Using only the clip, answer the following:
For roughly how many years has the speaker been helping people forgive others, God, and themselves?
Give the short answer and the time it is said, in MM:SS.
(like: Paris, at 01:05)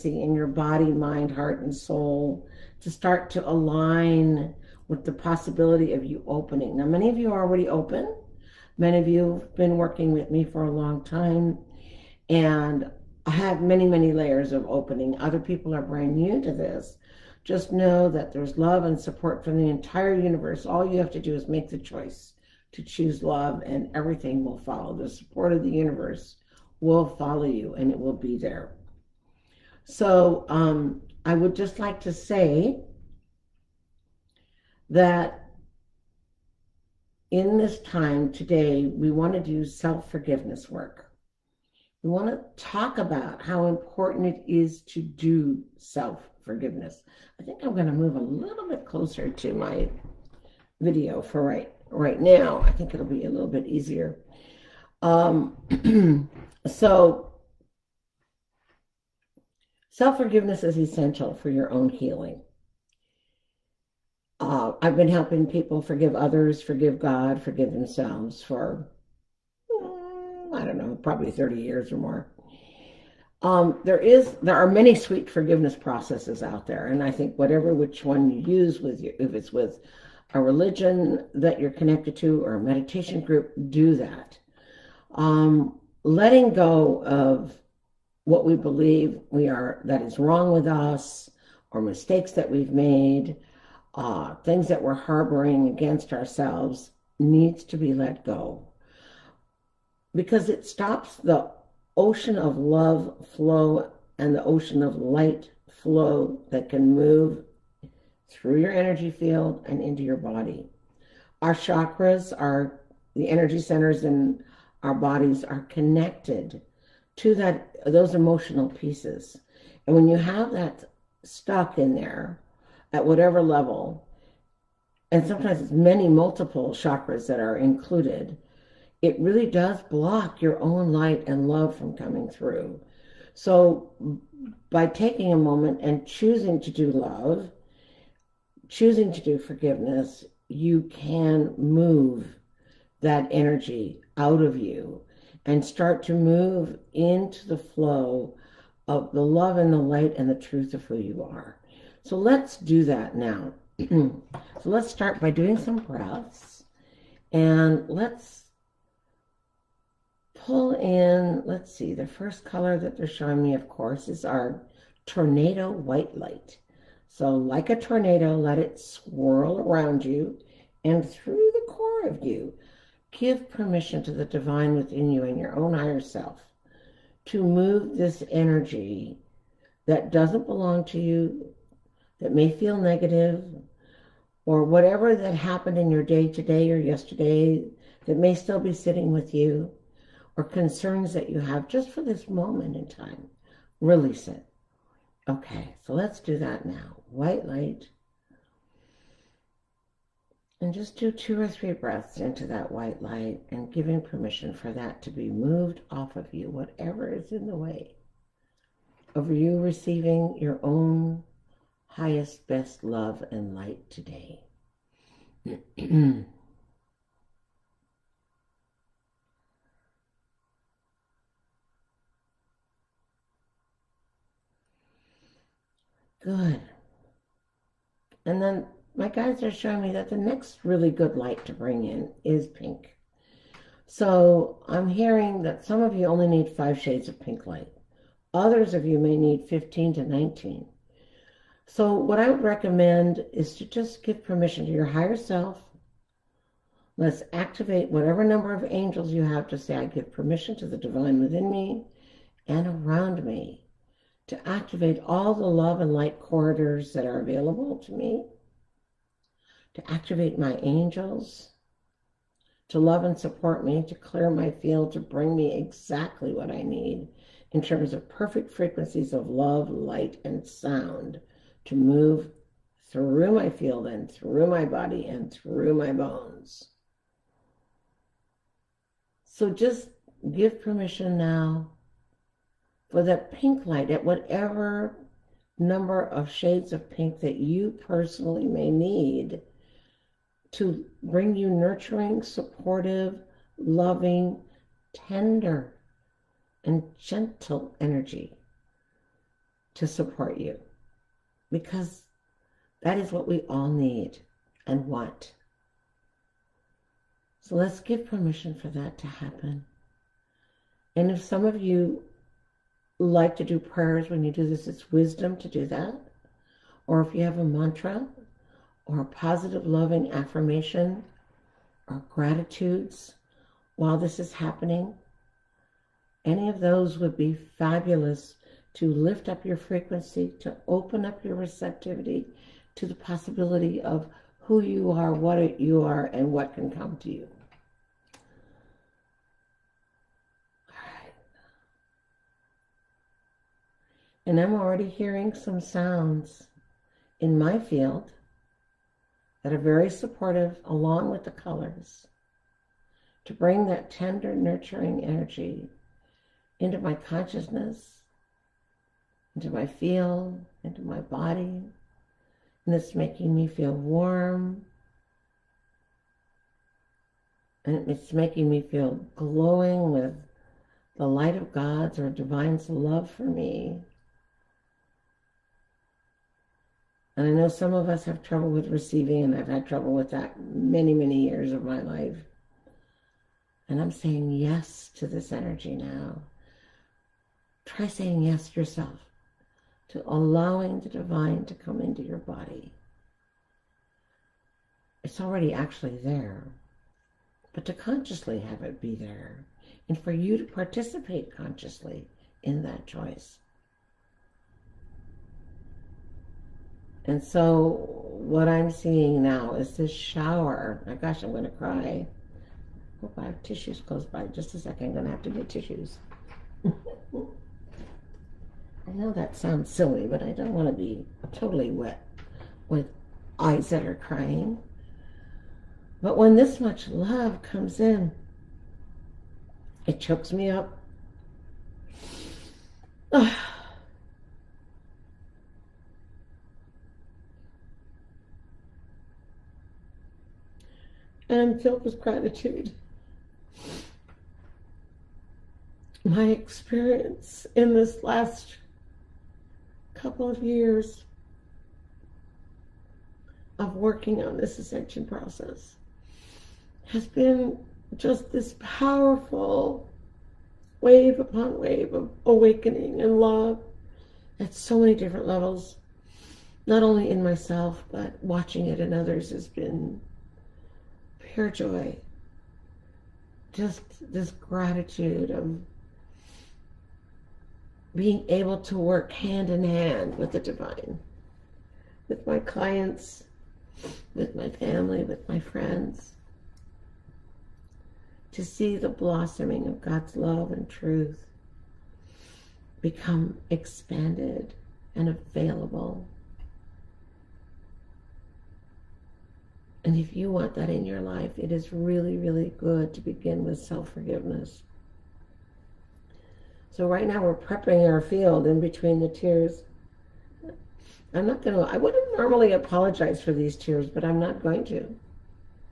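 30, at 01:11.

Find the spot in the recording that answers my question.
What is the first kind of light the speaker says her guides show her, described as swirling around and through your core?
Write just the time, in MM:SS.
02:45.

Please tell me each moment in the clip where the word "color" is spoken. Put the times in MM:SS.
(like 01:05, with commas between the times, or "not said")
02:42, 05:51.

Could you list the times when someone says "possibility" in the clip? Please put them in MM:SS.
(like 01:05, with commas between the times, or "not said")
00:05, 05:32.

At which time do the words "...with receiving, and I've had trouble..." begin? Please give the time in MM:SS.
06:18.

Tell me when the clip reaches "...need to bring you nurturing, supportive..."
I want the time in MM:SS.
04:48.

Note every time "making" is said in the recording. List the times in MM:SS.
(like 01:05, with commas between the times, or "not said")
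06:02, 06:08.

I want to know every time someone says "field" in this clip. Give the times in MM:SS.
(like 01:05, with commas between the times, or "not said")
01:49, 04:24, 04:33, 05:47, 05:59, 08:28.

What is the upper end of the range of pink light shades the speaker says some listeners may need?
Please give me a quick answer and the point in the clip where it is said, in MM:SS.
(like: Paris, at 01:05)
19, at 04:00.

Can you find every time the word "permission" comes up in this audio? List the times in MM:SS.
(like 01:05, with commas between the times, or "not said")
02:53, 03:24, 04:04, 04:10, 04:40, 05:08.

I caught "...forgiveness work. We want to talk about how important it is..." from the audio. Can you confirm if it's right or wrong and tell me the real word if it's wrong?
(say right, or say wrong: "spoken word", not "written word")
right.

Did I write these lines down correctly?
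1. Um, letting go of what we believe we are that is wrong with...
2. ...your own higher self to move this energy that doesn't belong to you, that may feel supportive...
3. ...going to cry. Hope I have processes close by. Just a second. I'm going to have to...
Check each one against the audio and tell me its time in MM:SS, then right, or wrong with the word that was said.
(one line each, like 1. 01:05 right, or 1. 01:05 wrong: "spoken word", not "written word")
1. 01:25 right
2. 02:55 wrong: "negative", not "supportive"
3. 06:51 wrong: "tissues", not "processes".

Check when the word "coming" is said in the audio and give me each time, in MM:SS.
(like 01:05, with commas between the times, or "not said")
02:11.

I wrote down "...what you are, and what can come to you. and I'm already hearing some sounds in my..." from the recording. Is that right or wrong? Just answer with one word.
right.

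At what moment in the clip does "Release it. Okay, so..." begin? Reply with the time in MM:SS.
03:13.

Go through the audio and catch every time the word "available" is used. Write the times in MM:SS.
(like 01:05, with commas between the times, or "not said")
04:17, 08:15.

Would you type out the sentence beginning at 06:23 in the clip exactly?
And I'm saying yes to this energy now.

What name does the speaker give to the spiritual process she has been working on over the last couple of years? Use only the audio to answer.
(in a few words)
ascension process.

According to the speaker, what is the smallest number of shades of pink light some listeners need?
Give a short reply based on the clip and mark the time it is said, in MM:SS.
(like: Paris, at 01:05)
5, at 03:56.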